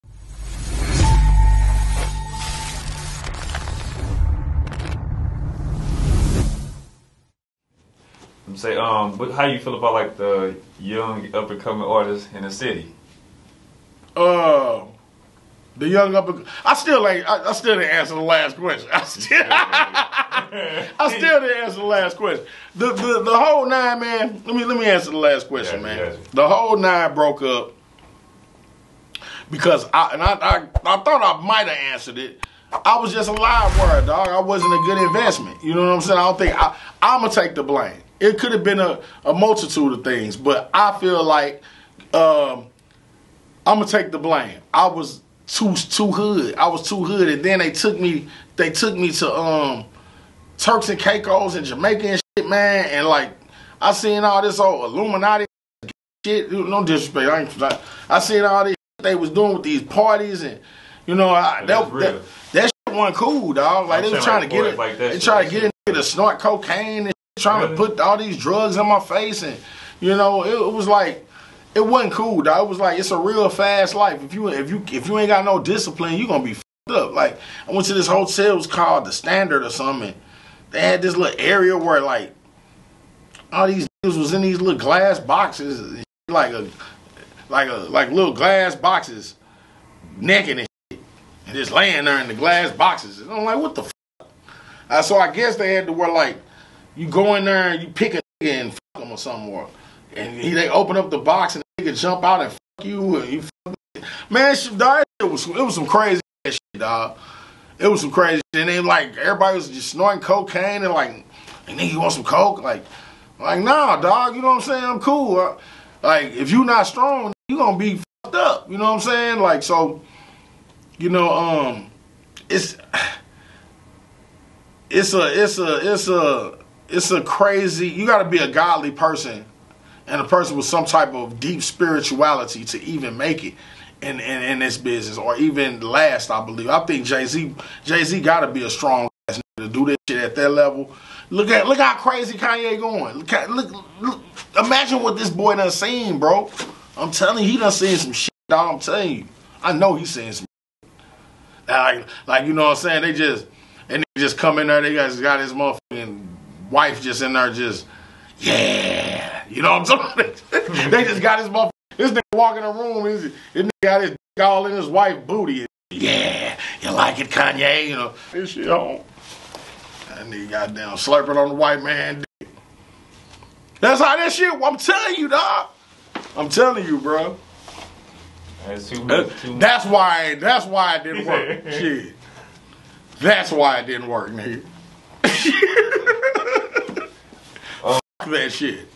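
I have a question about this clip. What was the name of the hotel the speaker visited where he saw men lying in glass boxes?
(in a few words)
The Standard.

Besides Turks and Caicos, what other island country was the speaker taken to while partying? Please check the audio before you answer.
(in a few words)
Jamaica.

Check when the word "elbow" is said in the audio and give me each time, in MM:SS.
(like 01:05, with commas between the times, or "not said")
not said.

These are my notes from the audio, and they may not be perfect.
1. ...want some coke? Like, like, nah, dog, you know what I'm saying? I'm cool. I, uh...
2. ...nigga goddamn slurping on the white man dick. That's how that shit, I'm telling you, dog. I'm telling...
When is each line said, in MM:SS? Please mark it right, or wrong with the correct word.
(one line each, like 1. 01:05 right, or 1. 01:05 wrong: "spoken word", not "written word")
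1. 01:52 right
2. 02:50 right.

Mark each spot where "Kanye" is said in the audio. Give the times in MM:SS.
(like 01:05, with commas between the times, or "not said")
02:22, 02:47.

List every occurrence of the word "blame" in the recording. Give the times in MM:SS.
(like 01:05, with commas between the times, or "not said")
00:37, 00:44.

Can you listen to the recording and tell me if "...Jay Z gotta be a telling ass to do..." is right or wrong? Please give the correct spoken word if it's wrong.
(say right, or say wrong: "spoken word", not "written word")
wrong: "strong", not "telling".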